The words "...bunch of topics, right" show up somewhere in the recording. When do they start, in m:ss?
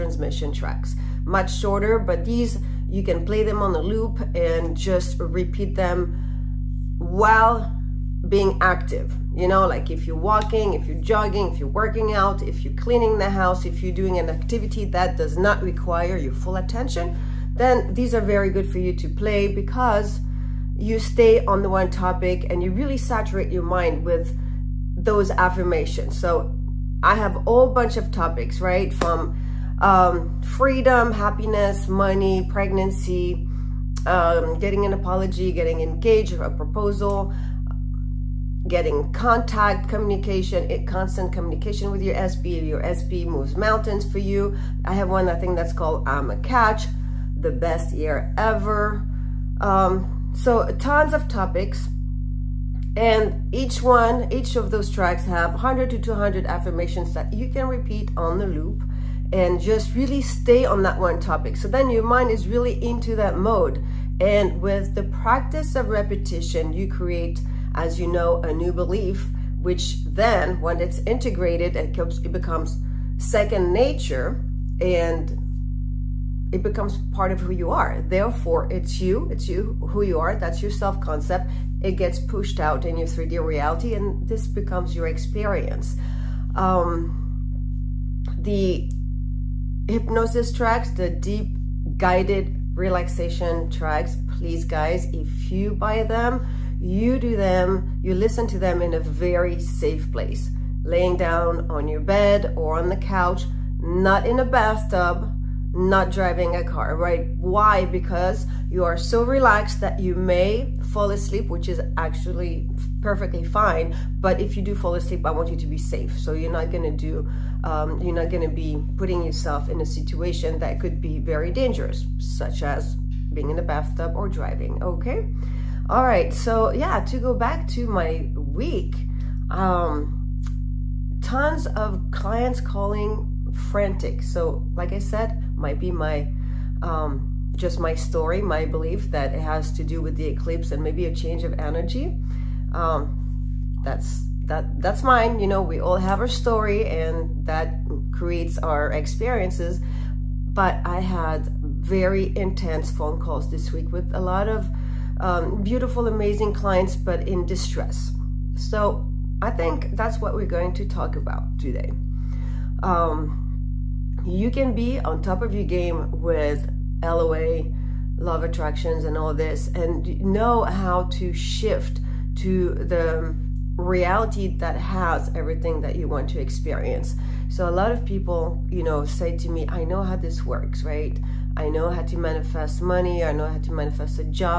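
0:27.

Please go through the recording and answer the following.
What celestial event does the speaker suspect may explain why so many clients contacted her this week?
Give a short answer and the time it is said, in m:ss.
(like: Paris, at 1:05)
the eclipse, at 2:20.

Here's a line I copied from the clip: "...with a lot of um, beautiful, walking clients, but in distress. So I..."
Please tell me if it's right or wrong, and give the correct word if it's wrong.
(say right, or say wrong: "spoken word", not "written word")
wrong: "amazing", not "walking".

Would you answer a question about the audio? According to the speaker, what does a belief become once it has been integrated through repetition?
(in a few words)
second nature.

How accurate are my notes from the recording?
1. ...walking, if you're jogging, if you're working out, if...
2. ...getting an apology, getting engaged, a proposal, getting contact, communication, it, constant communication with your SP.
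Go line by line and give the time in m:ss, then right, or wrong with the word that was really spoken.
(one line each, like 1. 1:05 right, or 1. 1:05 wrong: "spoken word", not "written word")
1. 0:10 right
2. 0:34 right.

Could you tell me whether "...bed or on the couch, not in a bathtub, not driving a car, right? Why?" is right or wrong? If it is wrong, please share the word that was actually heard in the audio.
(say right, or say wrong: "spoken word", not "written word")
right.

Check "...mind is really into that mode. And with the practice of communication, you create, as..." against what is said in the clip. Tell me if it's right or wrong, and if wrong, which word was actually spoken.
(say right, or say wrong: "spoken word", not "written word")
wrong: "repetition", not "communication".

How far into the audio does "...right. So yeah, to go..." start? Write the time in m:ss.
2:06.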